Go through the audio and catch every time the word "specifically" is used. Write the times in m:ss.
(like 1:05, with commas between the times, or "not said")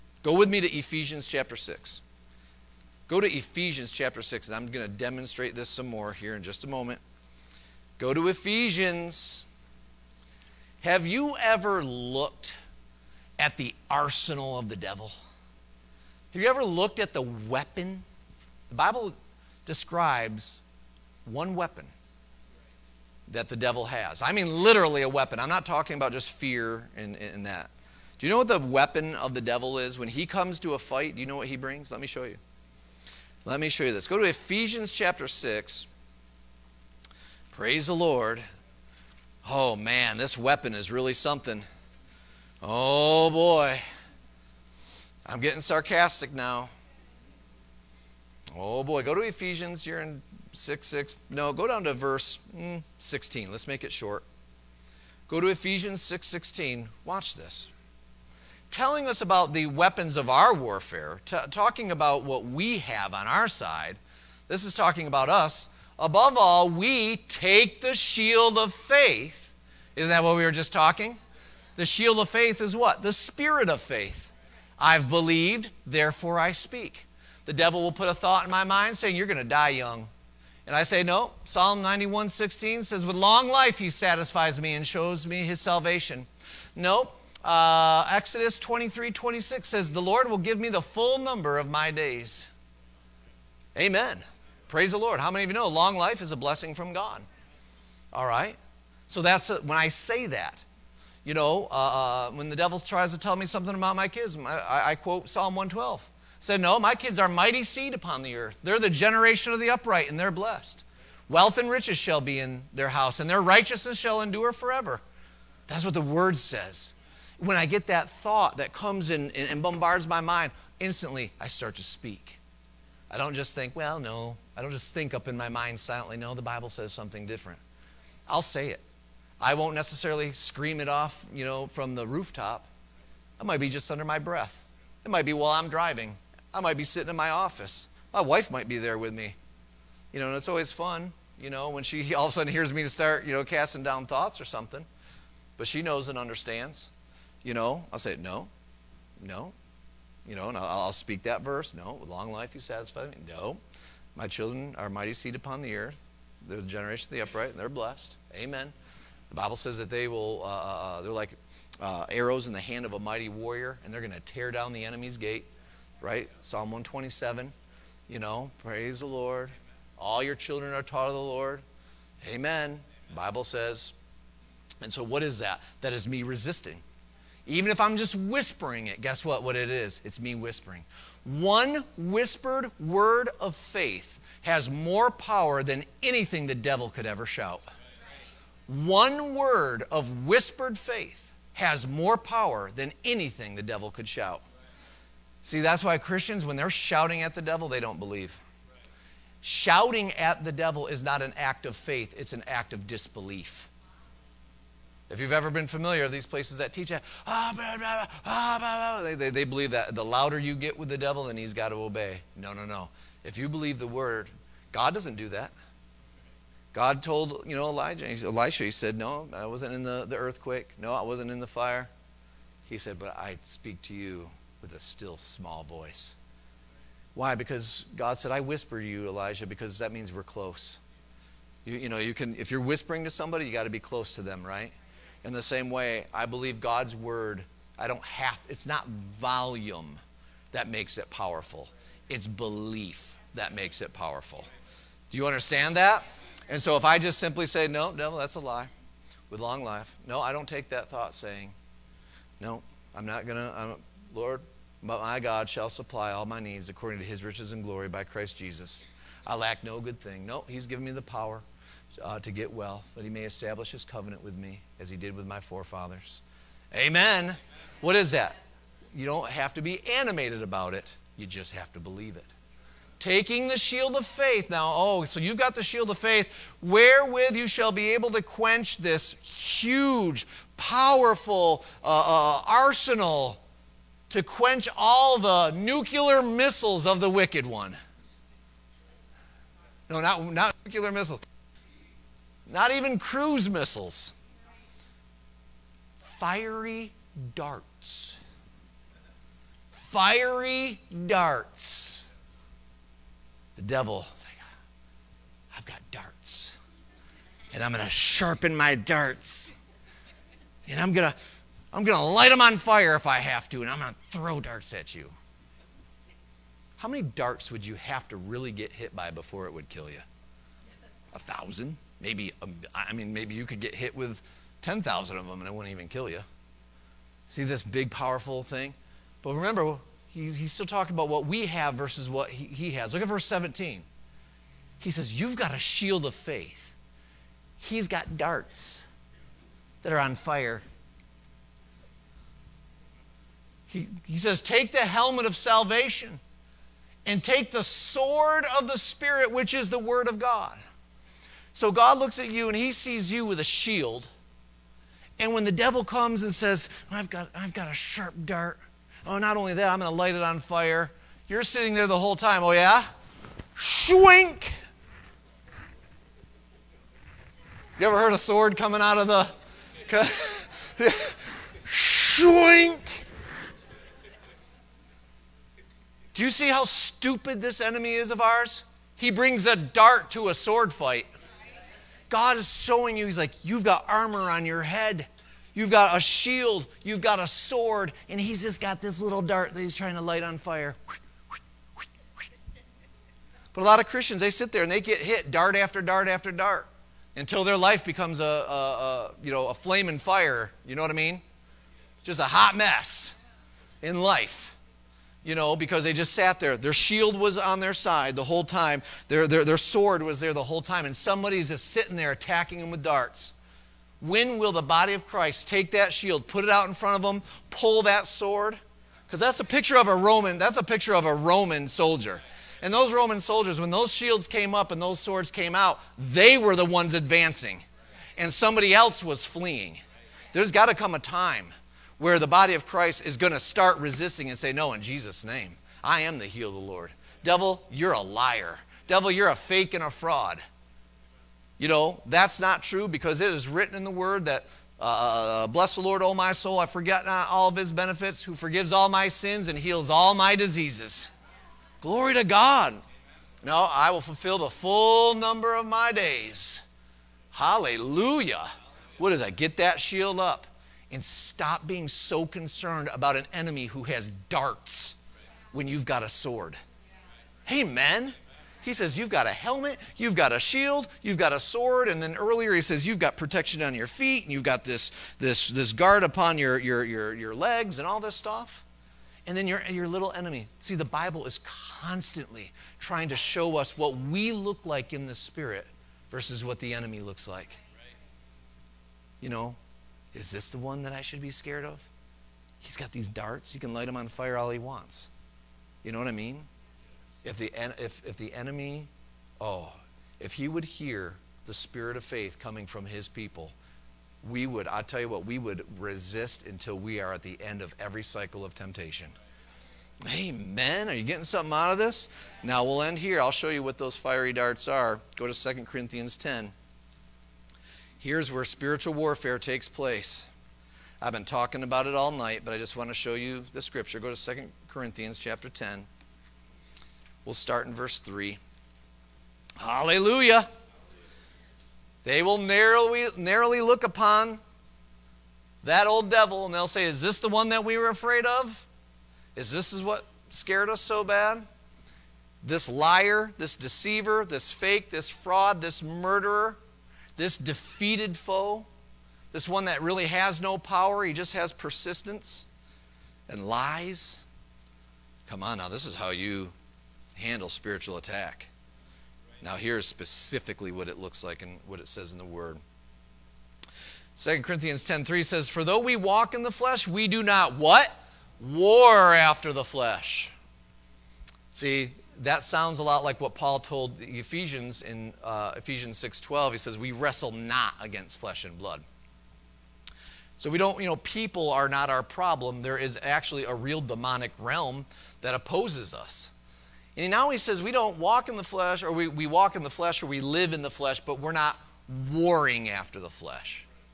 9:19.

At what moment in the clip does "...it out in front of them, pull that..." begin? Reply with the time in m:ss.
6:56.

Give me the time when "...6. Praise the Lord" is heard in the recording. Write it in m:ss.
0:35.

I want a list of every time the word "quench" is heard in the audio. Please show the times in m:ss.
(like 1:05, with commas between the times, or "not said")
4:38, 4:44.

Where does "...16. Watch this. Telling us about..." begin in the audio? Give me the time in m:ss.
0:56.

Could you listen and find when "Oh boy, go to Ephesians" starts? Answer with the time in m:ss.
0:48.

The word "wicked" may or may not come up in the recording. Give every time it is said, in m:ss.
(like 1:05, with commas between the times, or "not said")
4:47.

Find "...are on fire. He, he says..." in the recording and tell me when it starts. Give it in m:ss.
5:39.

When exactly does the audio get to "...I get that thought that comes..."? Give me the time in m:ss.
1:57.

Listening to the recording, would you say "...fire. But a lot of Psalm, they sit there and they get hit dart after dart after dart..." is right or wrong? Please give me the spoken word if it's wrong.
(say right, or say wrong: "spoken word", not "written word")
wrong: "Christians", not "Psalm".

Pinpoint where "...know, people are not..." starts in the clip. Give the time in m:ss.
9:40.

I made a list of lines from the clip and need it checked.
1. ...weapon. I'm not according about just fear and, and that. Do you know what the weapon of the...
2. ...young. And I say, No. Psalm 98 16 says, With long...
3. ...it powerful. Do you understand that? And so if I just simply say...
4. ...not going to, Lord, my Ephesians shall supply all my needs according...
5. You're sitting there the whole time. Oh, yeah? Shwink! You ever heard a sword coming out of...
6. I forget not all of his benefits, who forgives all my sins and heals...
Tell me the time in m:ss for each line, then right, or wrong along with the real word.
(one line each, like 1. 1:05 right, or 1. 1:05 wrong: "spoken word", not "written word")
1. 0:25 wrong: "talking", not "according"
2. 1:19 wrong: "91", not "98"
3. 4:03 right
4. 4:13 wrong: "God", not "Ephesians"
5. 6:01 right
6. 7:26 right.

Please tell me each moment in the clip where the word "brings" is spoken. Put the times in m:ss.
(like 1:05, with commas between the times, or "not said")
0:31, 6:19.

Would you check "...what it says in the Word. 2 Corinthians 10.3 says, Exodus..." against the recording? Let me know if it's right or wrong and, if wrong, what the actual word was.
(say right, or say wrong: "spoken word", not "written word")
wrong: "For", not "Exodus".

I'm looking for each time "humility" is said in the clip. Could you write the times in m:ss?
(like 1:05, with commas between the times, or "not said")
not said.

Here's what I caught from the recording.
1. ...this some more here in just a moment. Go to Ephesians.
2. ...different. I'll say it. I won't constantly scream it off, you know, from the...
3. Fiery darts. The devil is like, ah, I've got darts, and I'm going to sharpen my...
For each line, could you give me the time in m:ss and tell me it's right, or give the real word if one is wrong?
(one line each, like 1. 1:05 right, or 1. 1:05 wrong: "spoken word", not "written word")
1. 0:05 right
2. 2:07 wrong: "necessarily", not "constantly"
3. 4:59 right.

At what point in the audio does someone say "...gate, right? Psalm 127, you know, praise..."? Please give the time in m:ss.
2:45.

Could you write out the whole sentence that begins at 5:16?
How many darts would you have to really get hit by before it would kill you?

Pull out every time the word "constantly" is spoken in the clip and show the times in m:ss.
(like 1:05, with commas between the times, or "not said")
8:01.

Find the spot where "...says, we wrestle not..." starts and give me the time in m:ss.
9:36.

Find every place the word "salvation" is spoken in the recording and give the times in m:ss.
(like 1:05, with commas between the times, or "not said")
1:25, 5:45.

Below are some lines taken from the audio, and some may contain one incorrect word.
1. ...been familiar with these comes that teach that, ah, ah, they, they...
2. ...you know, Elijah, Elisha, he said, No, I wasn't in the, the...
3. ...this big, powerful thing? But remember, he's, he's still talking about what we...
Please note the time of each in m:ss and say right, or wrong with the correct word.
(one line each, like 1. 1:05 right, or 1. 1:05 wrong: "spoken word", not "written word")
1. 3:25 wrong: "places", not "comes"
2. 3:37 right
3. 5:27 right.